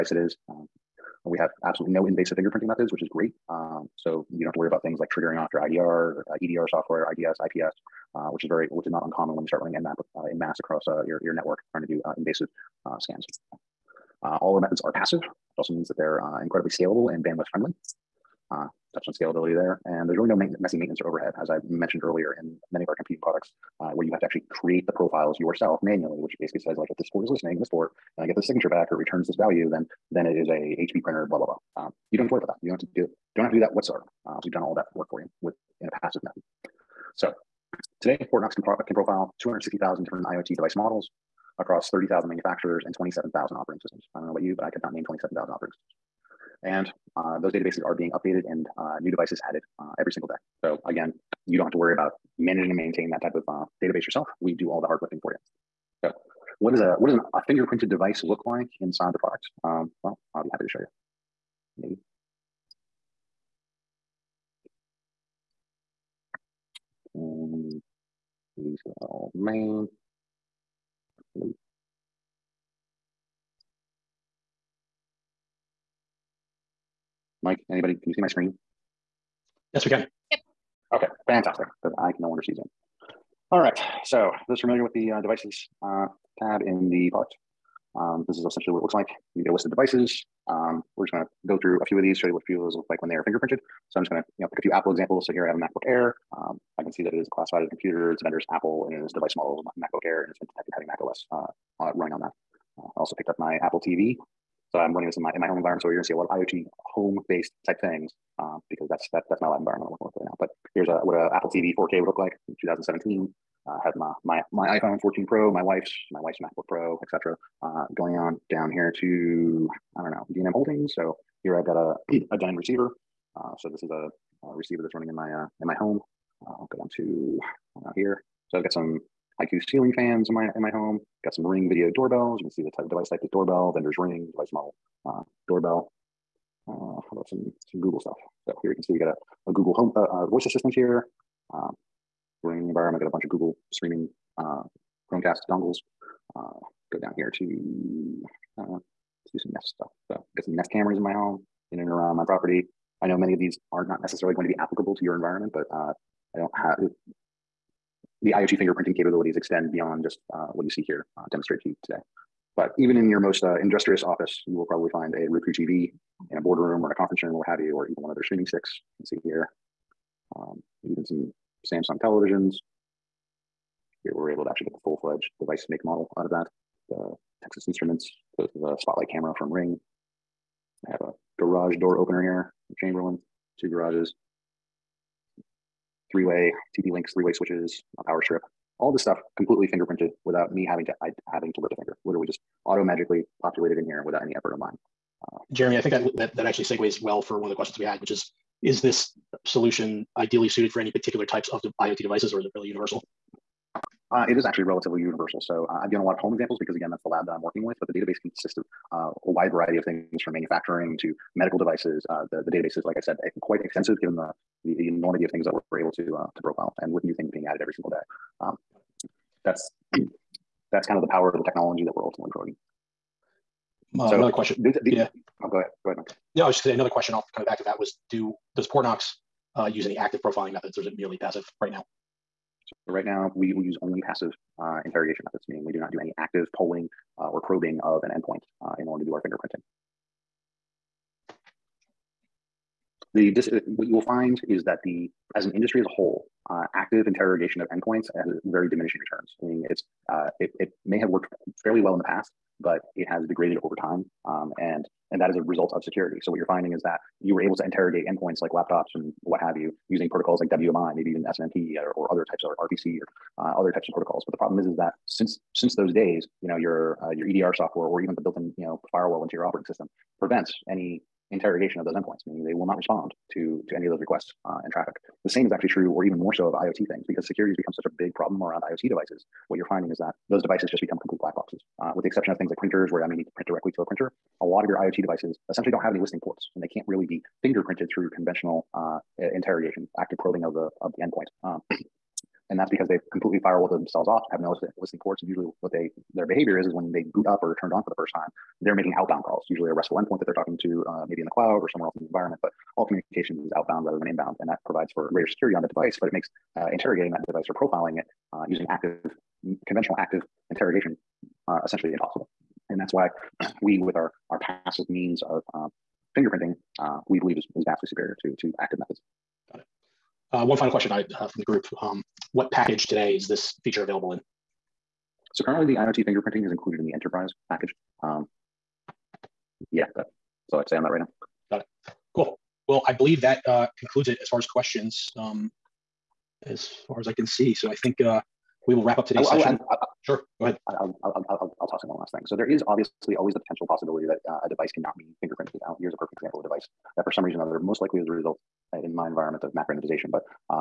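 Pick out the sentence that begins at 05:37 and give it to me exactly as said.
So I think uh, we will wrap up today's I will, session.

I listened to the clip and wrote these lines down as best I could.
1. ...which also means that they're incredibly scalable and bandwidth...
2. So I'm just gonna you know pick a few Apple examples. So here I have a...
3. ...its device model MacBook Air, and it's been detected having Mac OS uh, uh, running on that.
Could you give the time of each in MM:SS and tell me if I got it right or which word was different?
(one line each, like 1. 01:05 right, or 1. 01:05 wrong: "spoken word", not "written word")
1. 00:15 right
2. 01:33 right
3. 01:39 right.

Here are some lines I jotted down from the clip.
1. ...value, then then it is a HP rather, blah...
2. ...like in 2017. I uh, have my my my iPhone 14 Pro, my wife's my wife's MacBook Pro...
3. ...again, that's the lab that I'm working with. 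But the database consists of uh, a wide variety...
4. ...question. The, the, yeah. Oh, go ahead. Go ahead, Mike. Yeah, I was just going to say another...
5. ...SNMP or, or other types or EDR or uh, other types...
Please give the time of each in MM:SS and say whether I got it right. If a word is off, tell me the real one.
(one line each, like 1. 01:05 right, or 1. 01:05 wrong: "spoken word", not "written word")
1. 00:29 wrong: "printer", not "rather"
2. 01:52 right
3. 03:26 right
4. 03:44 right
5. 04:21 wrong: "RPC", not "EDR".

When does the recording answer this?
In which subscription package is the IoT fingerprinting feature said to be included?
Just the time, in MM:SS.
05:26.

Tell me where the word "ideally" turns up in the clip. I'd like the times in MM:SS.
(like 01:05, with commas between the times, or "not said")
03:20.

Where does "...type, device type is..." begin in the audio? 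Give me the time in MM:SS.
02:12.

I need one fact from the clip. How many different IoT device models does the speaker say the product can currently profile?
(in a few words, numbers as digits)
260,000.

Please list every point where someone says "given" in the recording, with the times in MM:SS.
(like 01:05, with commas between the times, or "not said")
03:25, 03:34.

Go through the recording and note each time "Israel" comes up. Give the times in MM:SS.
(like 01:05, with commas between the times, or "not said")
not said.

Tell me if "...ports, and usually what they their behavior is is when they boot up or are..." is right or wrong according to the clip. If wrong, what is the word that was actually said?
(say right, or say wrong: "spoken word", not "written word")
right.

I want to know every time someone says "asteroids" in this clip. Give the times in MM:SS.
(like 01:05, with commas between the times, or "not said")
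not said.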